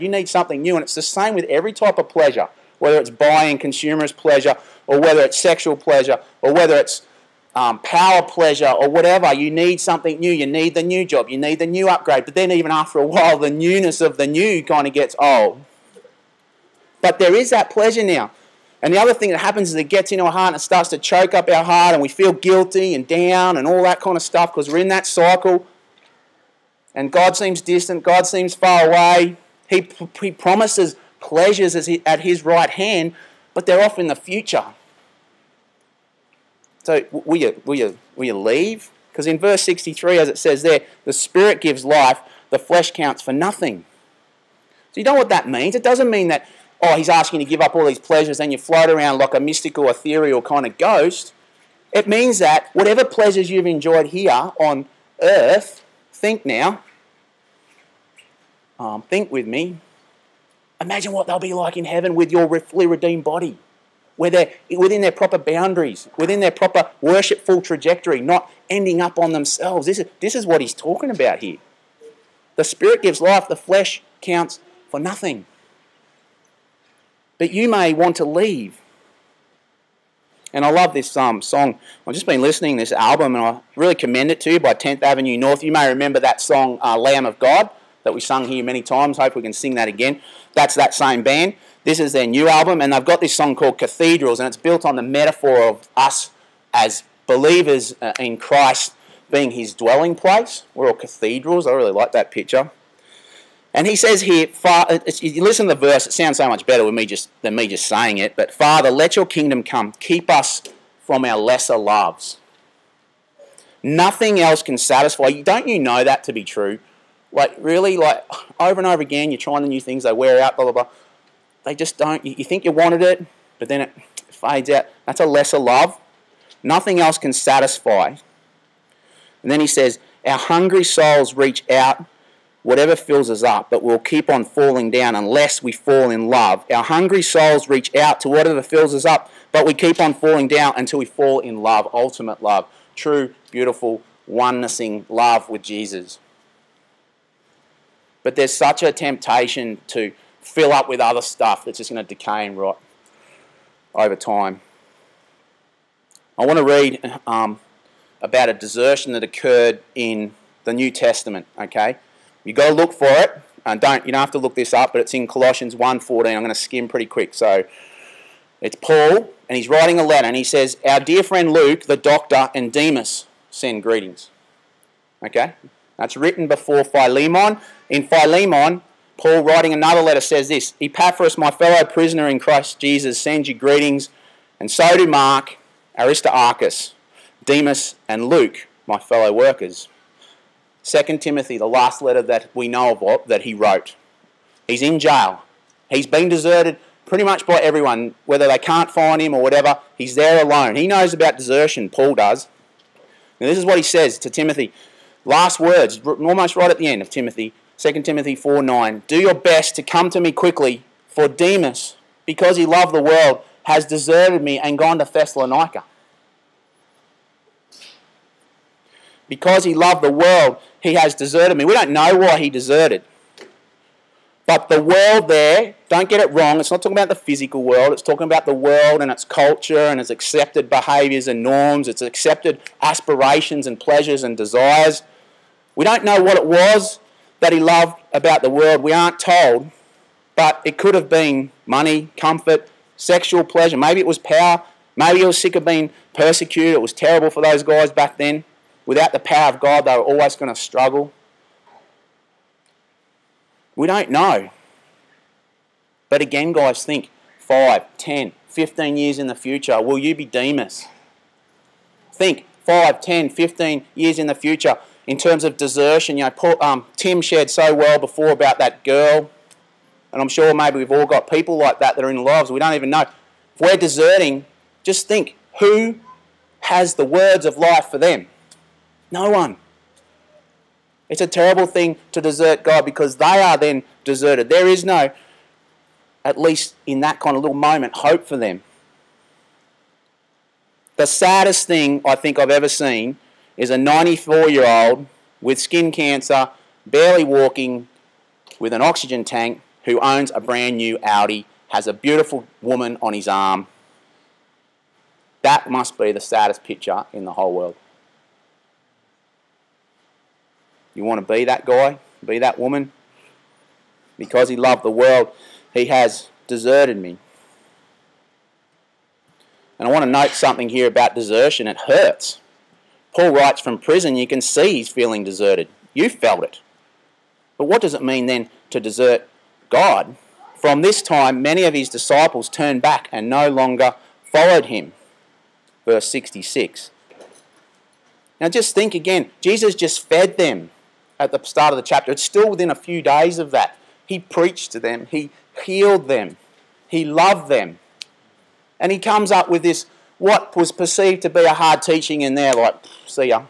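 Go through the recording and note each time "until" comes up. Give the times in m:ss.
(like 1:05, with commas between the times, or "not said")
2:20.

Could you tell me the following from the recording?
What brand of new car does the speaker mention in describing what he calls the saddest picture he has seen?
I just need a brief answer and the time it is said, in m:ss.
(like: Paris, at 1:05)
Audi, at 5:01.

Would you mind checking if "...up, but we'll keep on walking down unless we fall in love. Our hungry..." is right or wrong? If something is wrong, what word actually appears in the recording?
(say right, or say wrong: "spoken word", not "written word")
wrong: "falling", not "walking".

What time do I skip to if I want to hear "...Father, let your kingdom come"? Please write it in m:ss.
1:48.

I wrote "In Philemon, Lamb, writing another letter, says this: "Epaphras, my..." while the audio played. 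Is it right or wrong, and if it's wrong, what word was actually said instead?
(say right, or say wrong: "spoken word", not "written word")
wrong: "Paul", not "Lamb".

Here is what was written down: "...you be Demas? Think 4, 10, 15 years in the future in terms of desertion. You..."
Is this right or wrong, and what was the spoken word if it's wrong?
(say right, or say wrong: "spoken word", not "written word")
wrong: "5", not "4".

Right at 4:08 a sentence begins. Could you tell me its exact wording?
Without the power of God, they were always going to struggle.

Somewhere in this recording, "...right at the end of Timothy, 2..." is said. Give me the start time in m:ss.
3:26.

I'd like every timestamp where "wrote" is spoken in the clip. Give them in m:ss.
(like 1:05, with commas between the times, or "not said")
3:13.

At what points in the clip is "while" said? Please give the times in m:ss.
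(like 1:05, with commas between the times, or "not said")
0:13.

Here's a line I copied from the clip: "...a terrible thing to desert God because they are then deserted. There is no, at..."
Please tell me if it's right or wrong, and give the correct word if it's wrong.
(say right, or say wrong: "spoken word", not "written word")
right.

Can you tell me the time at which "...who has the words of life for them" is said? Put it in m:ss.
4:35.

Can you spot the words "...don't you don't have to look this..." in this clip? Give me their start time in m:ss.
2:43.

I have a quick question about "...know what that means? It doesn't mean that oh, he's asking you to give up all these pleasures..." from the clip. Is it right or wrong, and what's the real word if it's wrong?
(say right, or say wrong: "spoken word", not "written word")
right.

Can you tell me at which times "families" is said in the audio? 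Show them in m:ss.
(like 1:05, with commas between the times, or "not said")
not said.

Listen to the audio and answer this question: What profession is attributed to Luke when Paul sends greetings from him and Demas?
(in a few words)
Doctor.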